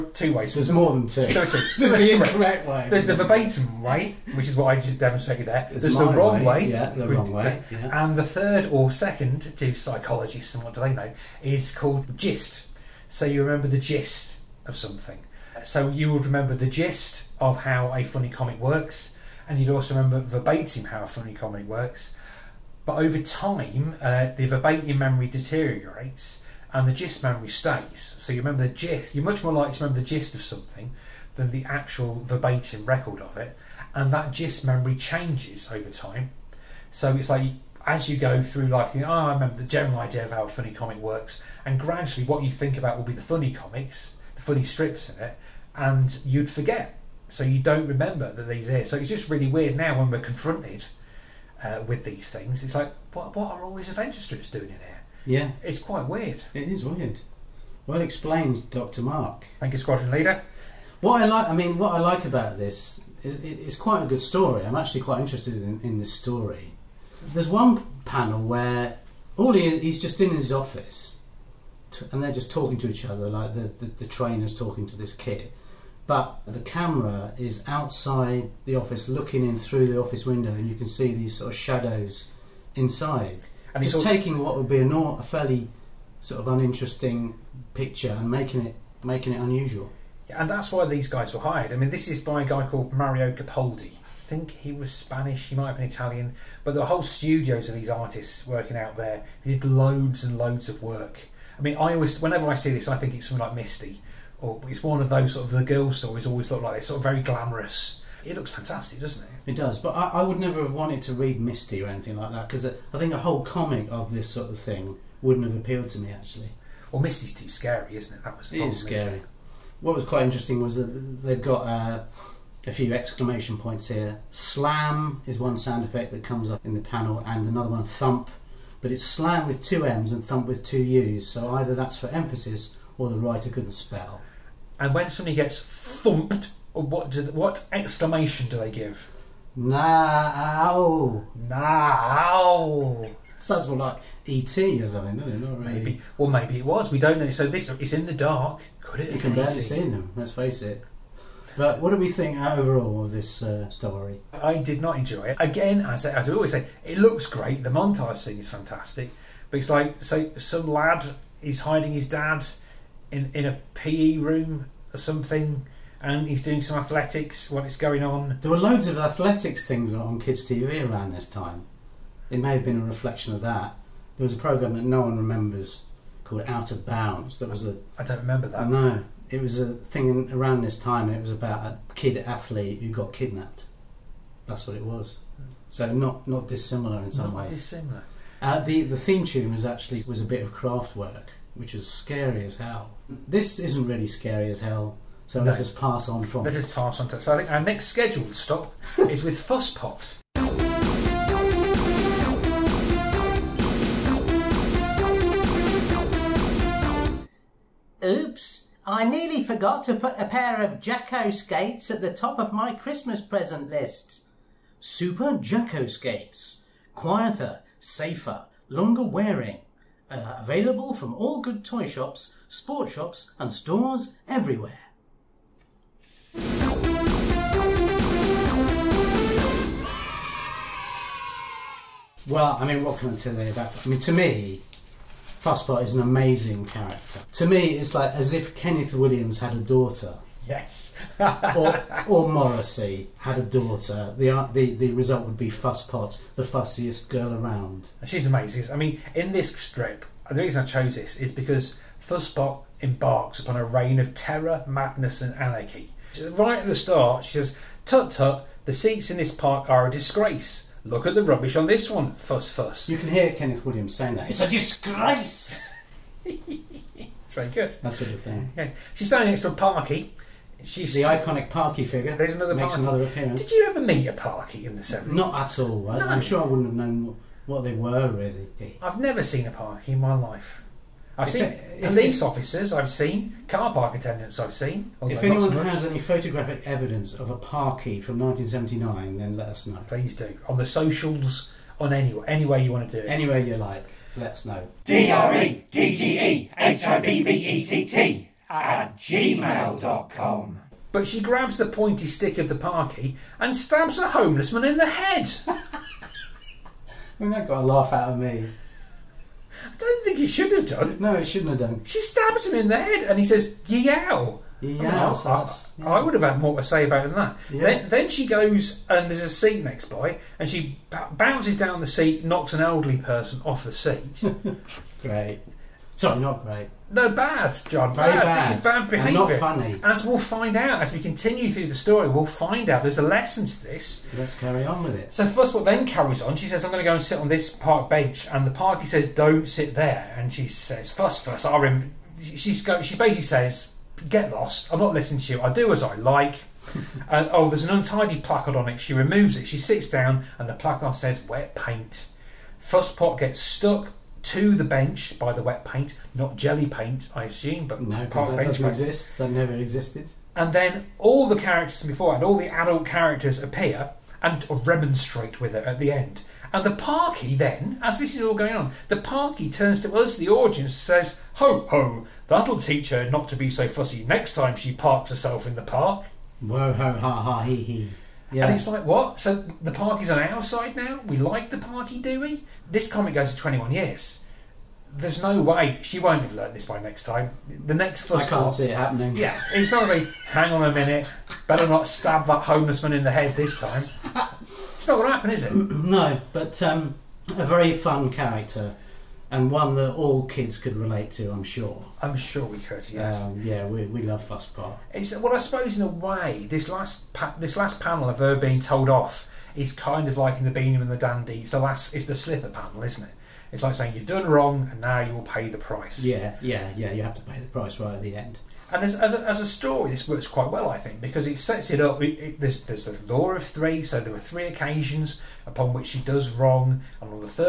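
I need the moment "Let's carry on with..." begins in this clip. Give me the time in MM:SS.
05:34.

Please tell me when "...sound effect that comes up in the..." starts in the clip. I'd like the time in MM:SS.
02:05.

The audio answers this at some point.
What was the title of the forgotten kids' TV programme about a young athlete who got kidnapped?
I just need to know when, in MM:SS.
02:56.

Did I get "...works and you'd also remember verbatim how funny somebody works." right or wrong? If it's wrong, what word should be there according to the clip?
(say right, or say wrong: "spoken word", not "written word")
wrong: "comedy", not "somebody".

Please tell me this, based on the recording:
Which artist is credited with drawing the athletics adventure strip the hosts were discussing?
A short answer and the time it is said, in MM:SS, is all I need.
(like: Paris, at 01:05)
Mario Capaldi, at 01:32.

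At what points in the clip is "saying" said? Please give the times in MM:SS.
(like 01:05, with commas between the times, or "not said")
04:23, 06:53.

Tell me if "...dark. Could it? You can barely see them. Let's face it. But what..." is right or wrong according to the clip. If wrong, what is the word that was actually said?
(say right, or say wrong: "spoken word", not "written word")
right.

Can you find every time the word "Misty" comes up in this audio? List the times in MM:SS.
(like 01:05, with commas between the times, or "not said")
01:43, 01:51, 01:57.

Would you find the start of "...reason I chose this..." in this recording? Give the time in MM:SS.
04:10.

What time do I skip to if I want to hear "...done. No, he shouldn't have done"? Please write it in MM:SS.
05:10.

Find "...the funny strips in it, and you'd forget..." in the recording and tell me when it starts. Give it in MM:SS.
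00:44.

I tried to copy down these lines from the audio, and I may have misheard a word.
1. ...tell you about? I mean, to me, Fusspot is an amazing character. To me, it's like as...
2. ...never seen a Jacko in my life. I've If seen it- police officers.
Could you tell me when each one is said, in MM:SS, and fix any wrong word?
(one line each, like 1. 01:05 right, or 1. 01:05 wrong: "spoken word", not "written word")
1. 03:53 right
2. 04:38 wrong: "Parky", not "Jacko".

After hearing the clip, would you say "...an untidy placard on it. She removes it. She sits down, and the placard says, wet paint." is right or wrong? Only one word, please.
right.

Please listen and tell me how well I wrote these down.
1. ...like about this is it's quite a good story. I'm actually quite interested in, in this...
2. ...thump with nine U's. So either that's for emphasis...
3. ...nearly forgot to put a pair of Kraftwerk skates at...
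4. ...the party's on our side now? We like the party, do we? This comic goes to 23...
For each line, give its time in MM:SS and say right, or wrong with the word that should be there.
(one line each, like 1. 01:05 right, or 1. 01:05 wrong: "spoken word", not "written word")
1. 01:01 right
2. 02:10 wrong: "two", not "nine"
3. 03:29 wrong: "Jacko", not "Kraftwerk"
4. 06:19 wrong: "21", not "23".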